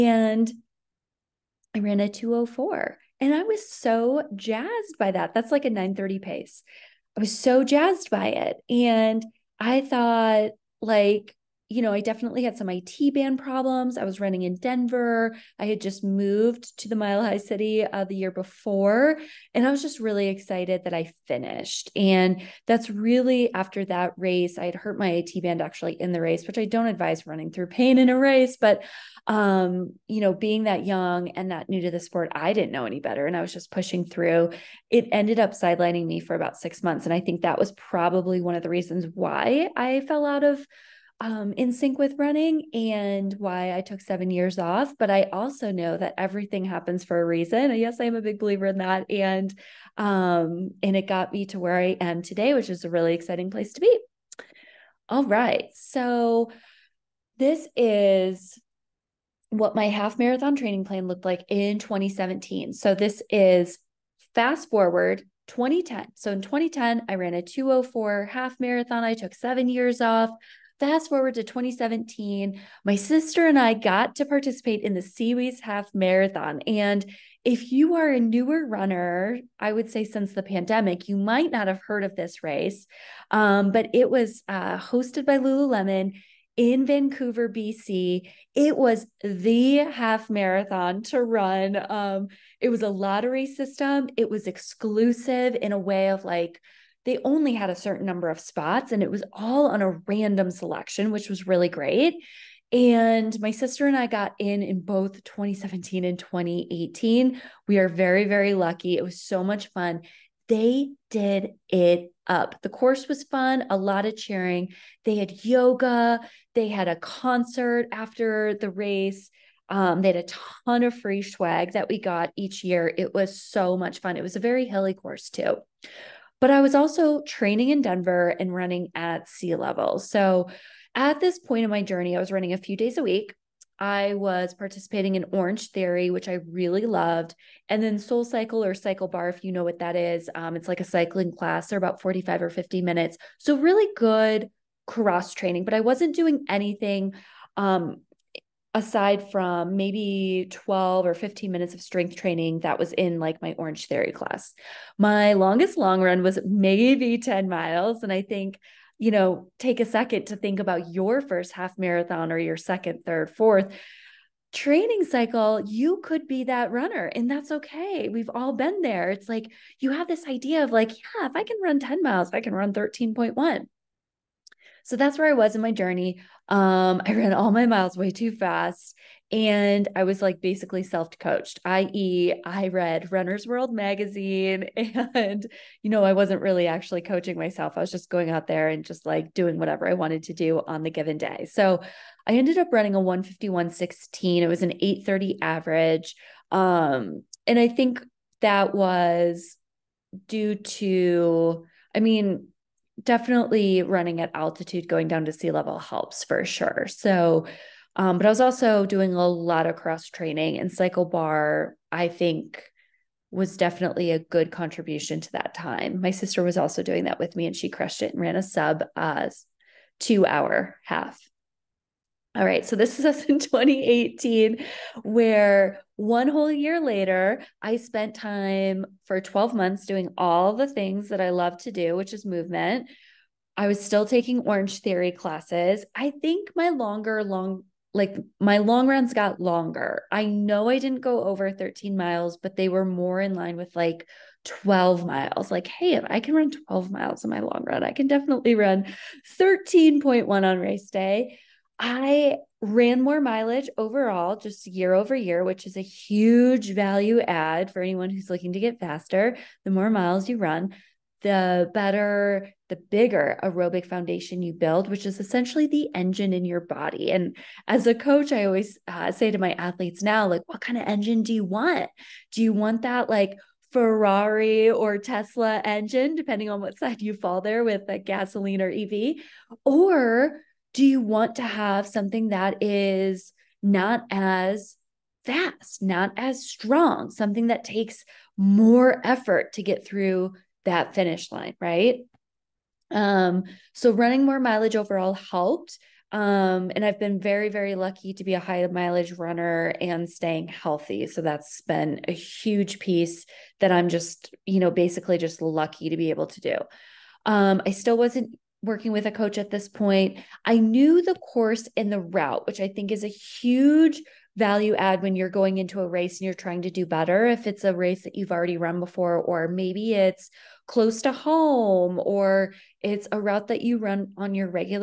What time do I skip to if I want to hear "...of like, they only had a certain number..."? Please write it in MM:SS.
01:36.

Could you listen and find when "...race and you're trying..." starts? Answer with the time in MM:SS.
05:15.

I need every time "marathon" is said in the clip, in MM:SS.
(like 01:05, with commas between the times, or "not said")
01:00, 01:08, 01:15, 01:30, 02:41.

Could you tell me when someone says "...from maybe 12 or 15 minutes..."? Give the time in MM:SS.
02:29.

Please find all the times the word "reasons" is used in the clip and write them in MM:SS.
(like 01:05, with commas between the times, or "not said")
00:38, 00:47.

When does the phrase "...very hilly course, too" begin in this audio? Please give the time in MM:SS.
02:04.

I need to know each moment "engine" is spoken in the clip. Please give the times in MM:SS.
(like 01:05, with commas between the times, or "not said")
04:25, 04:30, 04:35.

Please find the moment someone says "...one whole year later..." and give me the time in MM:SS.
03:45.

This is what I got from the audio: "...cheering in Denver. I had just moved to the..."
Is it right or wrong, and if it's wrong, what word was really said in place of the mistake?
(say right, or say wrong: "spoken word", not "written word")
wrong: "running", not "cheering".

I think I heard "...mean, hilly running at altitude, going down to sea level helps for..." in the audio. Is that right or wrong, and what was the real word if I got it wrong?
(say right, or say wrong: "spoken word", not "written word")
wrong: "definitely", not "hilly".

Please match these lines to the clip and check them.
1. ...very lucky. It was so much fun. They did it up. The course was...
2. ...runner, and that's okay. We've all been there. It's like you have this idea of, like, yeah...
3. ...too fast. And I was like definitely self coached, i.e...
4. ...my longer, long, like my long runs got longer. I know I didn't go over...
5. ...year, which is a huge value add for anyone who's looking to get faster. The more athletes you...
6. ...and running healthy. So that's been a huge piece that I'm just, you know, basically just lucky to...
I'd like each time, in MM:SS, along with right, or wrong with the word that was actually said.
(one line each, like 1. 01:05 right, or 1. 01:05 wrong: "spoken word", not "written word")
1. 01:48 right
2. 02:46 right
3. 02:58 wrong: "basically", not "definitely"
4. 03:56 right
5. 04:15 wrong: "miles", not "athletes"
6. 04:59 wrong: "staying", not "running".